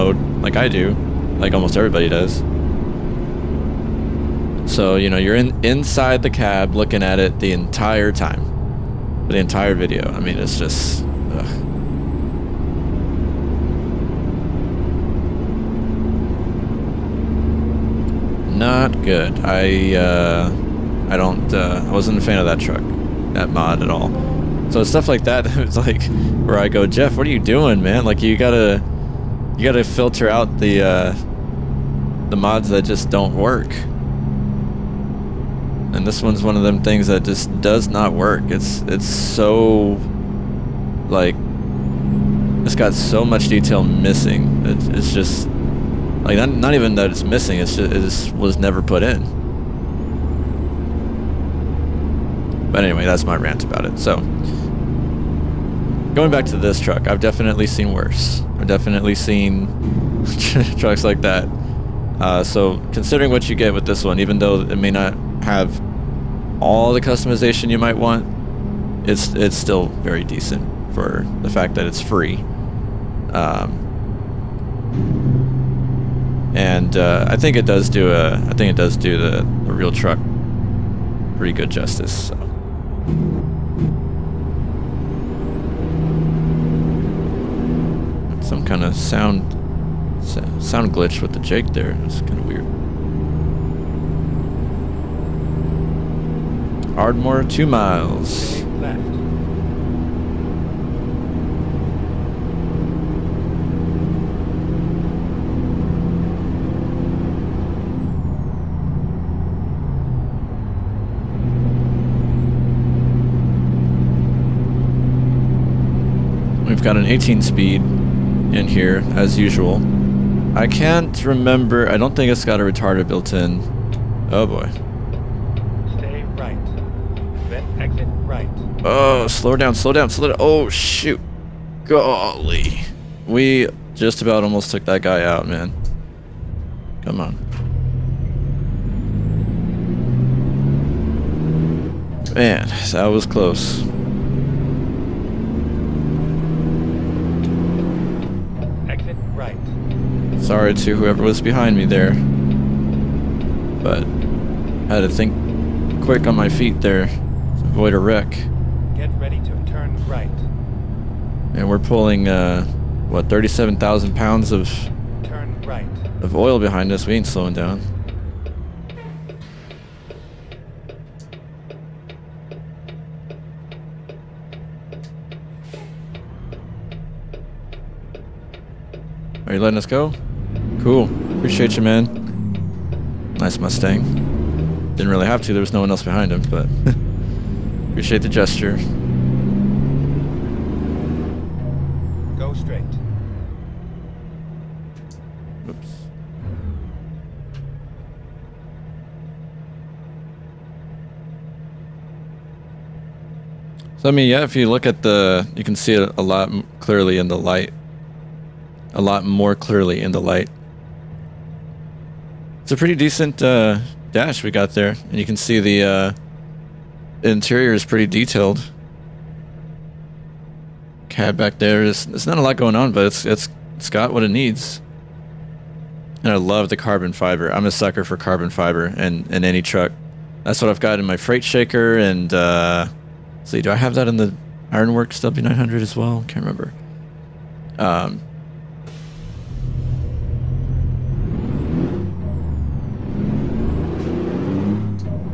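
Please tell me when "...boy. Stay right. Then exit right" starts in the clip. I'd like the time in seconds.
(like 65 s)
124 s.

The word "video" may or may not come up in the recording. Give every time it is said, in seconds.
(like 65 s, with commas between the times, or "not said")
9 s.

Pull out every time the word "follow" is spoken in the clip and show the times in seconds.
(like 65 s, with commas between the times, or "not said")
not said.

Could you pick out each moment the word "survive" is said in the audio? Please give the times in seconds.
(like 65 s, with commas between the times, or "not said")
not said.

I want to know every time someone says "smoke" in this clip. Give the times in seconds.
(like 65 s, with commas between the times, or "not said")
not said.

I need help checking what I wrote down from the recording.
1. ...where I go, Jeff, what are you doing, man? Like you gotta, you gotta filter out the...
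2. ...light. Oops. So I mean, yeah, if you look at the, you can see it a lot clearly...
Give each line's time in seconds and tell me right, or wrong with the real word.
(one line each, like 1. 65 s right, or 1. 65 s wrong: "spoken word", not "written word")
1. 26 s right
2. 192 s wrong: "straight", not "light".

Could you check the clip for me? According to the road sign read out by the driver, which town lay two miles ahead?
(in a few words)
Ardmore.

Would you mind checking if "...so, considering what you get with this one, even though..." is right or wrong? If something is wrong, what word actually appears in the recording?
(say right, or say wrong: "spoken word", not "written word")
right.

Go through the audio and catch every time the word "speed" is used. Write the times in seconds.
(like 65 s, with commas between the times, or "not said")
117 s.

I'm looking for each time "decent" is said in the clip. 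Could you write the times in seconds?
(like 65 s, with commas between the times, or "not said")
70 s, 212 s.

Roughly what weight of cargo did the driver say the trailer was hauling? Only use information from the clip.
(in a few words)
37,000 pounds.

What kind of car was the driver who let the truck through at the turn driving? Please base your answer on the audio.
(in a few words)
Mustang.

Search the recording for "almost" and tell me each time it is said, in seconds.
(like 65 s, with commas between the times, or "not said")
1 s, 134 s.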